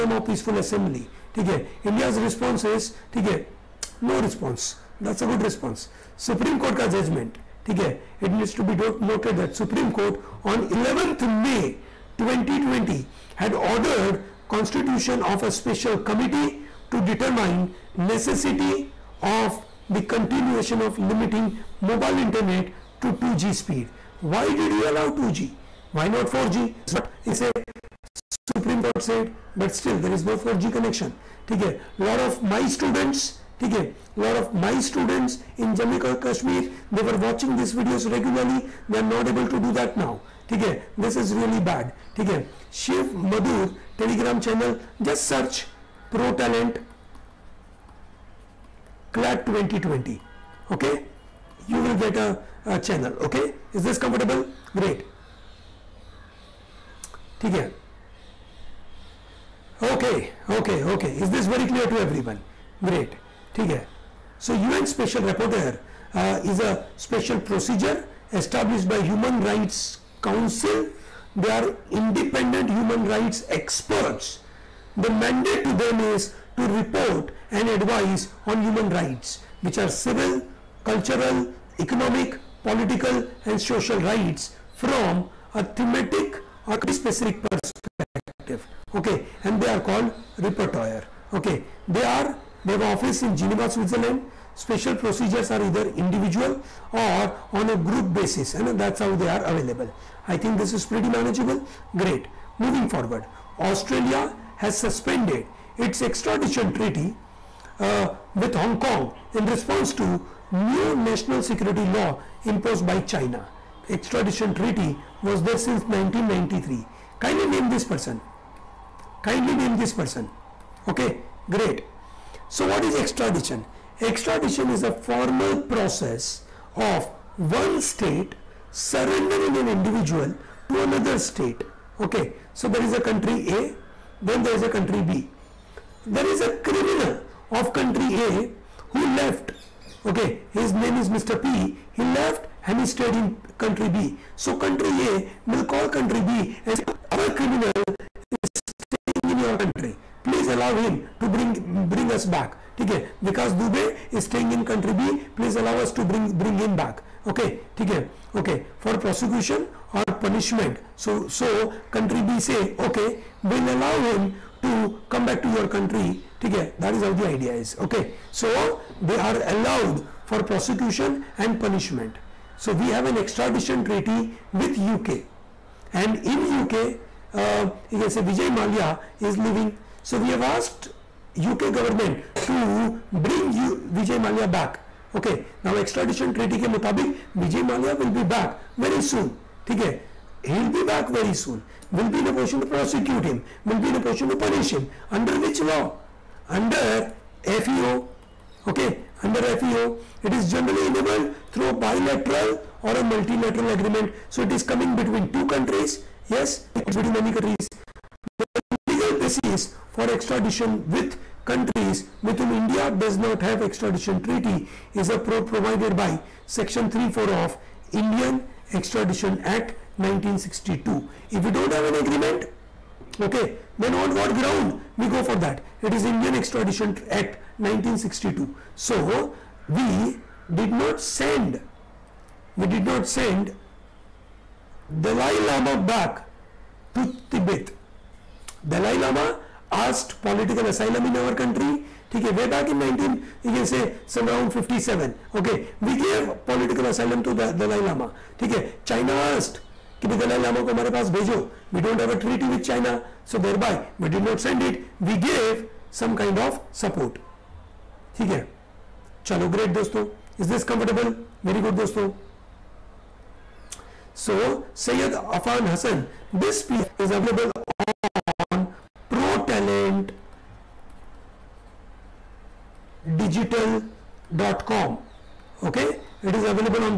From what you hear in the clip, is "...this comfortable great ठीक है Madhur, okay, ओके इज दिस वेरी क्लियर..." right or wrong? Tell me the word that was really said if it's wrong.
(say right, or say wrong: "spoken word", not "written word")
wrong: "Okay", not "Madhur".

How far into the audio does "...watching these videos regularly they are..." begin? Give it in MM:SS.
00:37.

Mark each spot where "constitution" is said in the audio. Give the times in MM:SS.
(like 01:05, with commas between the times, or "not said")
00:14.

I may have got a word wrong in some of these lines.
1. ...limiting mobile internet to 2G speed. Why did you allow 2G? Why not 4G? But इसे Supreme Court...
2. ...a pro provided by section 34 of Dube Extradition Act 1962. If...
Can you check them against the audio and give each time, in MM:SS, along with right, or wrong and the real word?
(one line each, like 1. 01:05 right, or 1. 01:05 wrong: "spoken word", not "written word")
1. 00:21 right
2. 03:35 wrong: "Indian", not "Dube".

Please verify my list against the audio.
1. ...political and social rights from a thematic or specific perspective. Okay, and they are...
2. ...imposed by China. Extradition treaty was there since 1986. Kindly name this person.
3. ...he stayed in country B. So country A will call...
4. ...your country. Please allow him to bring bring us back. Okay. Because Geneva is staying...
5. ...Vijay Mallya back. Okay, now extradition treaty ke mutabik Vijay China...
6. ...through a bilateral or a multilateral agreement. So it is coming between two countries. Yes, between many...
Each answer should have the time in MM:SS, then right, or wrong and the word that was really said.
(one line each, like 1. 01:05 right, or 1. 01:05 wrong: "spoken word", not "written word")
1. 01:22 right
2. 01:52 wrong: "1993", not "1986"
3. 02:22 right
4. 02:29 wrong: "Dube", not "Geneva"
5. 03:03 wrong: "Mallya", not "China"
6. 03:21 right.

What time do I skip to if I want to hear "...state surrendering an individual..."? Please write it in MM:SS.
02:07.